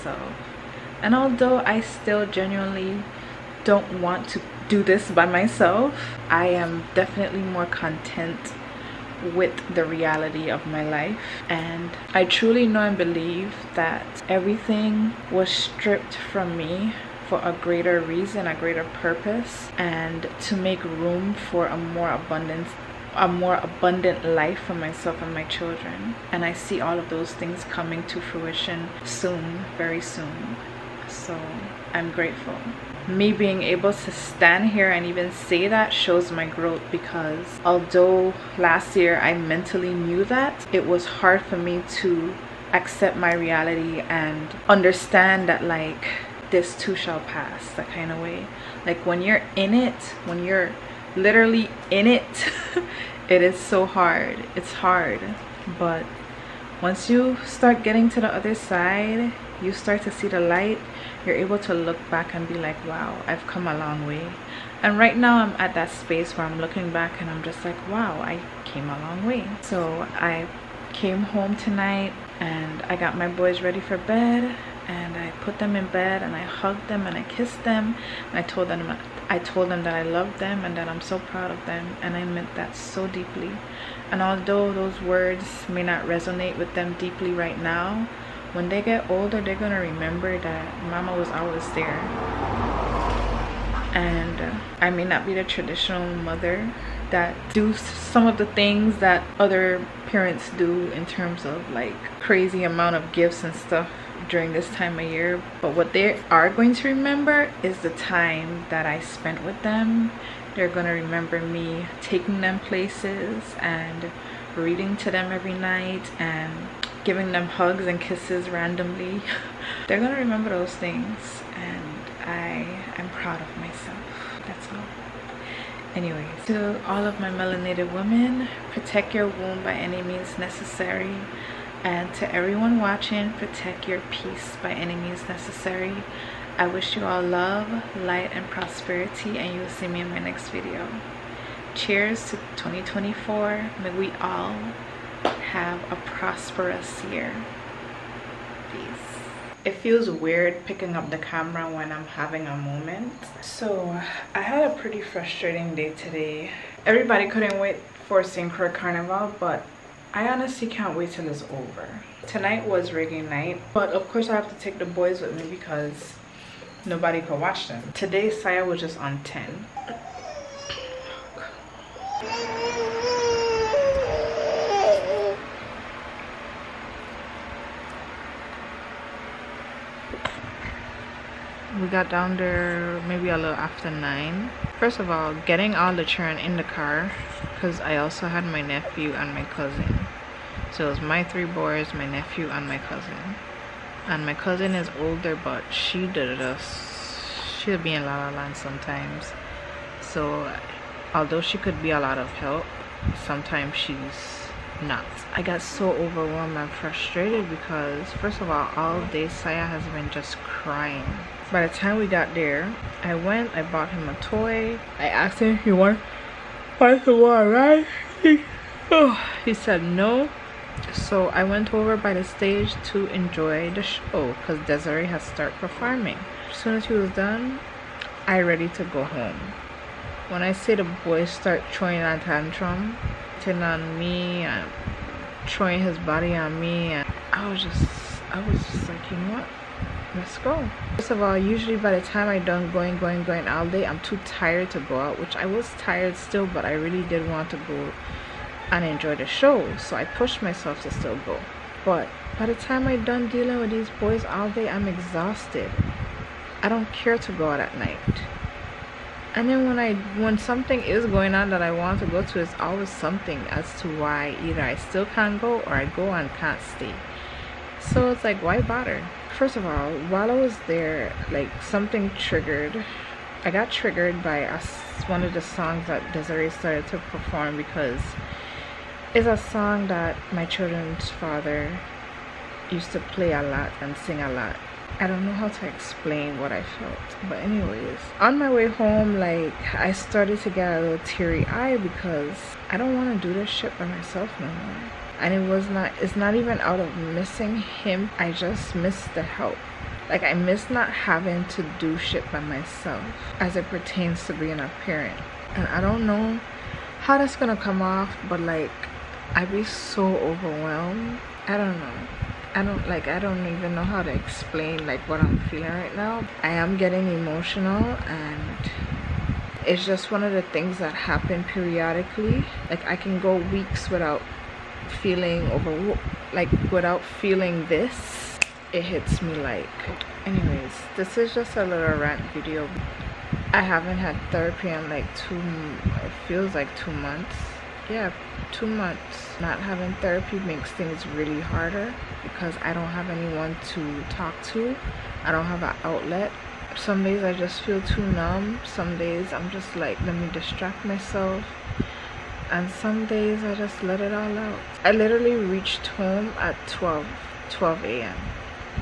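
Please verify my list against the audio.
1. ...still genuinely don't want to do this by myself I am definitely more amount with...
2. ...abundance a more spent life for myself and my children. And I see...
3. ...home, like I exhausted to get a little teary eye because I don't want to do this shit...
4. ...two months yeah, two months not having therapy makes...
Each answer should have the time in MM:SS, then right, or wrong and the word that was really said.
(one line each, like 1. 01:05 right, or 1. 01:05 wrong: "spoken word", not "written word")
1. 00:01 wrong: "content", not "amount"
2. 00:22 wrong: "abundant", not "spent"
3. 04:48 wrong: "started", not "exhausted"
4. 05:36 right.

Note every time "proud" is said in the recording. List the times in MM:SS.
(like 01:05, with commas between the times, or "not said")
01:21, 02:03.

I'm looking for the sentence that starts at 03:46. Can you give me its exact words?
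As soon as she was done, I ready to go home.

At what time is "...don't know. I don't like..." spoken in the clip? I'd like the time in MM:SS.
05:11.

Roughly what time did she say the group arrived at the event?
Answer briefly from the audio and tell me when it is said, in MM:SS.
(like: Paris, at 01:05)
A little after 9, at 03:03.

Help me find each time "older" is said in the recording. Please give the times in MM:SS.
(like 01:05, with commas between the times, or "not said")
01:29, 03:15.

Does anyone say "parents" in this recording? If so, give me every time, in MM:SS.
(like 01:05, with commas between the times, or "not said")
01:40, 05:04.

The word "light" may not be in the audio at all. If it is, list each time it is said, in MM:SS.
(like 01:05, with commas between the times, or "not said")
01:00, 02:18.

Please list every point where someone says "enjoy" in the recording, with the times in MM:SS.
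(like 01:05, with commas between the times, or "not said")
03:43, 04:08.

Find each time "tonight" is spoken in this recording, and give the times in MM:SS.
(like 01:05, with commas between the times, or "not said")
01:11, 02:42.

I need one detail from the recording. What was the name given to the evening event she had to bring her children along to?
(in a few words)
Rigging night.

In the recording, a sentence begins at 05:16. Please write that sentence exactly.
I am getting emotional and it's just one of the things that happen periodically.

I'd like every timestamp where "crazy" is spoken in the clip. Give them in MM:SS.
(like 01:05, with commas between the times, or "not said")
01:42.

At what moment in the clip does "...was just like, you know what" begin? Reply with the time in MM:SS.
03:58.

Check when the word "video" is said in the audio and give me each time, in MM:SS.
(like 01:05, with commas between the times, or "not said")
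02:20, 05:32.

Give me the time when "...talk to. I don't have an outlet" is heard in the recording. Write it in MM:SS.
05:44.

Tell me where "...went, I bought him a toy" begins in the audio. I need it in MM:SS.
03:33.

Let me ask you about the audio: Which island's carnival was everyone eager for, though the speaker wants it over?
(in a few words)
St. Croix.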